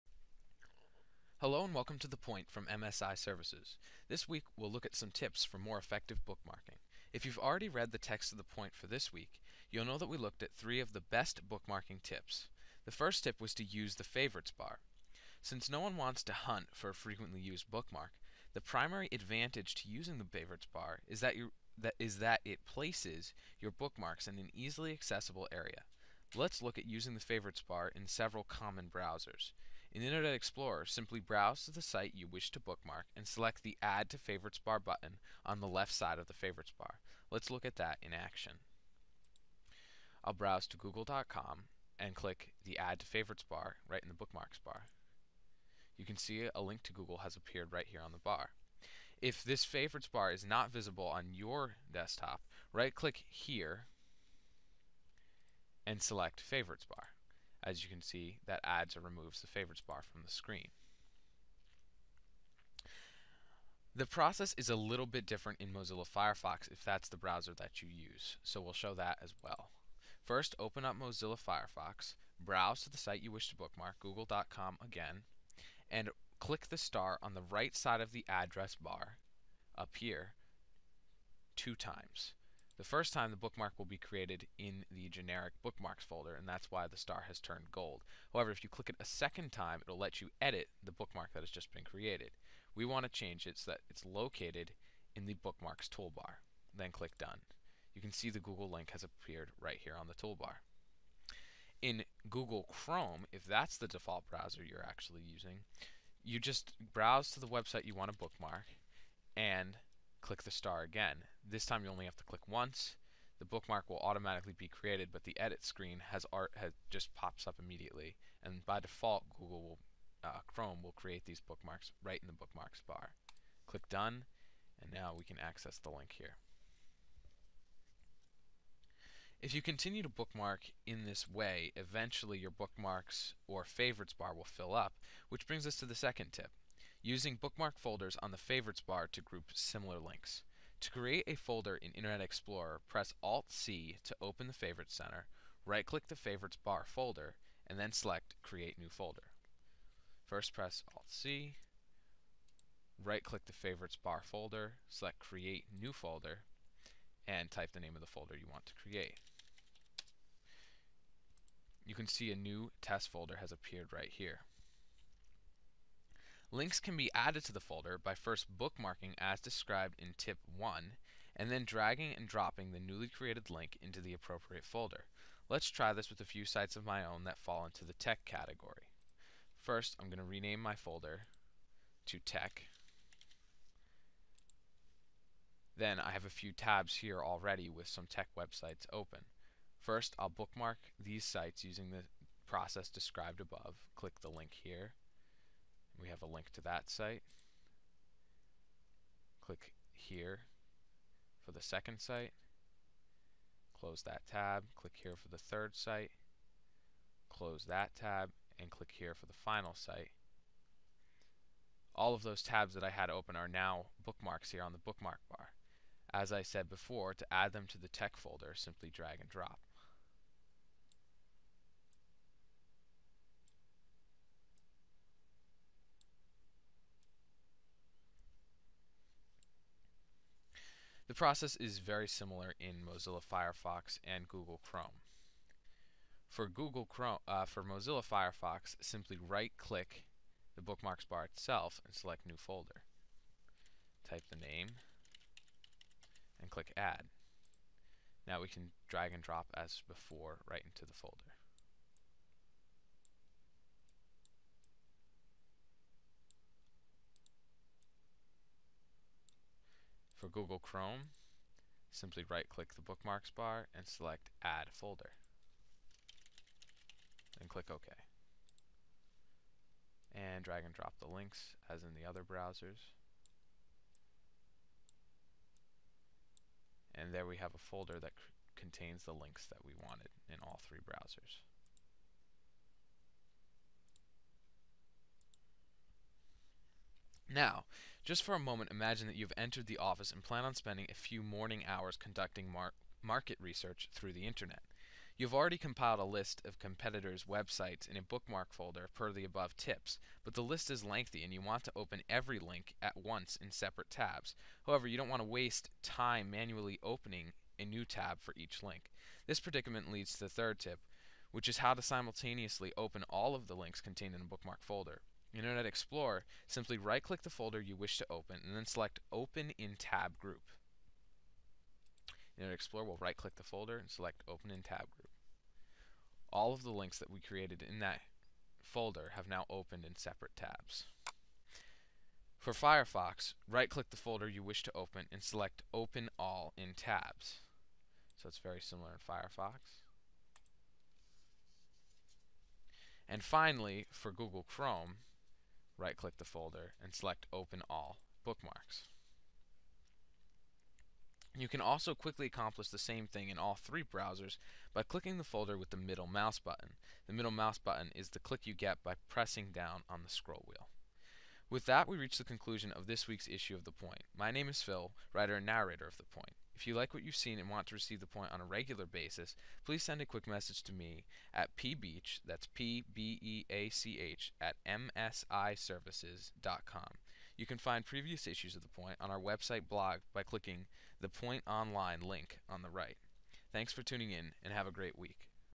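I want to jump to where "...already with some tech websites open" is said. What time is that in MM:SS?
03:07.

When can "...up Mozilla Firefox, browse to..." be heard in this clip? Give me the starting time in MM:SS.
01:10.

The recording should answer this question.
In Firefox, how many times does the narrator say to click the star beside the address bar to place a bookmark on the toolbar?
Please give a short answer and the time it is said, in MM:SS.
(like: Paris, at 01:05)
2, at 01:21.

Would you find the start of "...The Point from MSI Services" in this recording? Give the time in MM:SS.
00:02.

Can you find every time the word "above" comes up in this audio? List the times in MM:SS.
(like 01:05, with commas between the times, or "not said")
03:13, 04:59.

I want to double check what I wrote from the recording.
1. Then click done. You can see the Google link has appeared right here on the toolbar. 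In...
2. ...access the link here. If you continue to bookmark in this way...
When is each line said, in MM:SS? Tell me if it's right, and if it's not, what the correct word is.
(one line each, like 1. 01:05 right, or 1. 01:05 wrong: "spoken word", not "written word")
1. 01:36 right
2. 02:05 right.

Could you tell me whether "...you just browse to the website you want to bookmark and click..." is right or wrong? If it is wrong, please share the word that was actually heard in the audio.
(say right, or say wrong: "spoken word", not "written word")
right.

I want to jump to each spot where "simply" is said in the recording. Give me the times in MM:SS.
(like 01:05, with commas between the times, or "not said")
00:30, 03:38, 03:58, 04:21, 05:16.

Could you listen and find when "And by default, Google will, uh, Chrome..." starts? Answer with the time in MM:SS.
01:58.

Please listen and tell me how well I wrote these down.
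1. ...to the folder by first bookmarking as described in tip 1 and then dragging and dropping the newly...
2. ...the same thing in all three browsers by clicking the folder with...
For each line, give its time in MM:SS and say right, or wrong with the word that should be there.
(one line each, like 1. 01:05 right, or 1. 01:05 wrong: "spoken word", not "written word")
1. 02:47 right
2. 05:52 right.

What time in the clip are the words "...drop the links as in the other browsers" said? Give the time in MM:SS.
04:30.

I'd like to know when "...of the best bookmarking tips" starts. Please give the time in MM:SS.
00:10.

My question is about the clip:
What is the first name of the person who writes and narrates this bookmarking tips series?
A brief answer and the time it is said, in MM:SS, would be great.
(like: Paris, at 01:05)
Phil, at 06:04.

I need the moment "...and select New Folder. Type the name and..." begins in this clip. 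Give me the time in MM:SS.
04:01.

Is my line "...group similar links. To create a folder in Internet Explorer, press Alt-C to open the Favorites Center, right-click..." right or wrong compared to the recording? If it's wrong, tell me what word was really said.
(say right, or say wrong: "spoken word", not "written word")
right.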